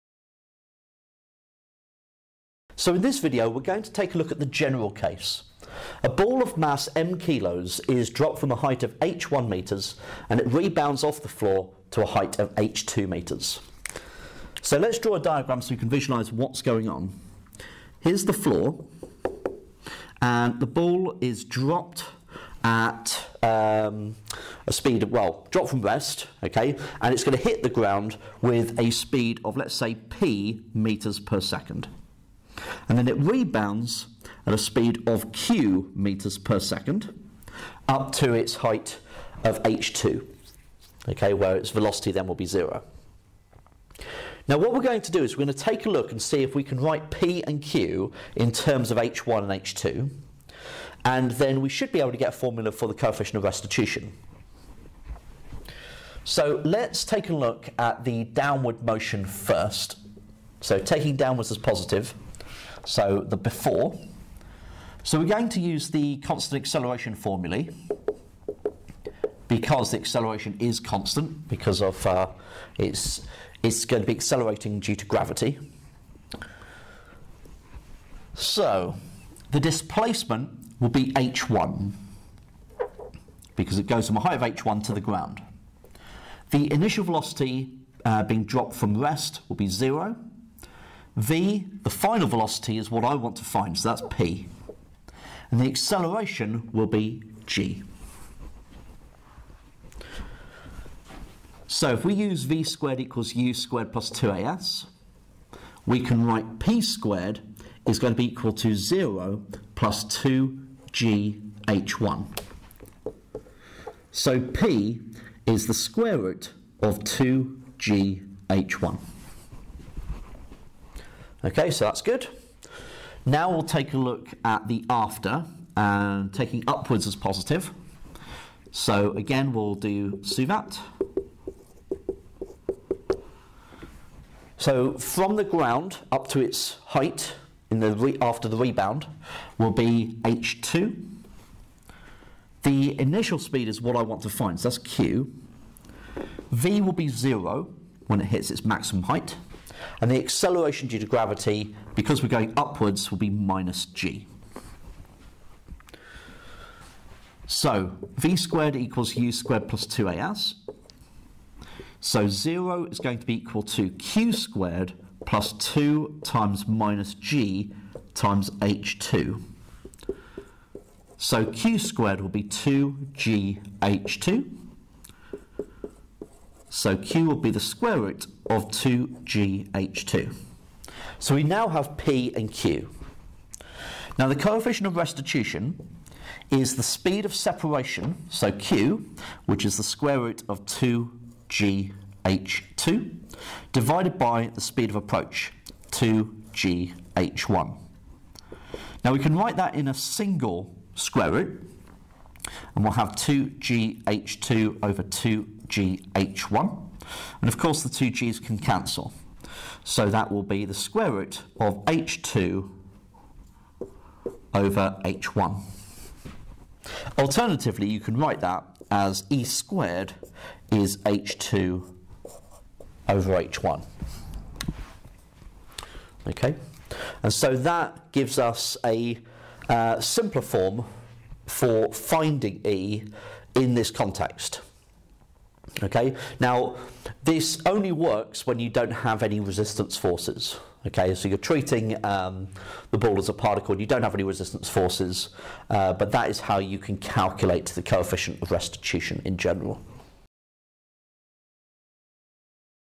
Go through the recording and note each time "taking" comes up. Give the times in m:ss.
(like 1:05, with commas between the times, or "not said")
1:00, 2:06.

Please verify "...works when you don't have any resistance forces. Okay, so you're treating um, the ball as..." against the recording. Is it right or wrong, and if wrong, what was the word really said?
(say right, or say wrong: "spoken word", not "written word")
right.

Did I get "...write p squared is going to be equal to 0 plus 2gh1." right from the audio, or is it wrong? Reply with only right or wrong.
right.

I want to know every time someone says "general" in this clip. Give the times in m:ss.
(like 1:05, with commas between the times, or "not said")
0:04, 4:09.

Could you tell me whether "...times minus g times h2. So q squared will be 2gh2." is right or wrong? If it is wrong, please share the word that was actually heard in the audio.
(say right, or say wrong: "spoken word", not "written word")
right.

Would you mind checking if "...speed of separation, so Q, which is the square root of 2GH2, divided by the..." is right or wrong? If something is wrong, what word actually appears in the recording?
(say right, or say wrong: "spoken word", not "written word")
right.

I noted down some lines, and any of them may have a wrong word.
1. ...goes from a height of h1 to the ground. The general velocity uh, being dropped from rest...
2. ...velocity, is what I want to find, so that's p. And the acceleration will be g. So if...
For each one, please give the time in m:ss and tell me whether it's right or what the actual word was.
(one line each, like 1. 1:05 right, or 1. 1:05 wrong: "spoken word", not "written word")
1. 1:23 wrong: "initial", not "general"
2. 1:32 right.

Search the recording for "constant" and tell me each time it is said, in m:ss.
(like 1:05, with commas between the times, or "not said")
1:06, 1:10.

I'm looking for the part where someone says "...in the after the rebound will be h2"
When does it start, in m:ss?
2:17.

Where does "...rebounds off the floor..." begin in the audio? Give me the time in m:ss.
0:10.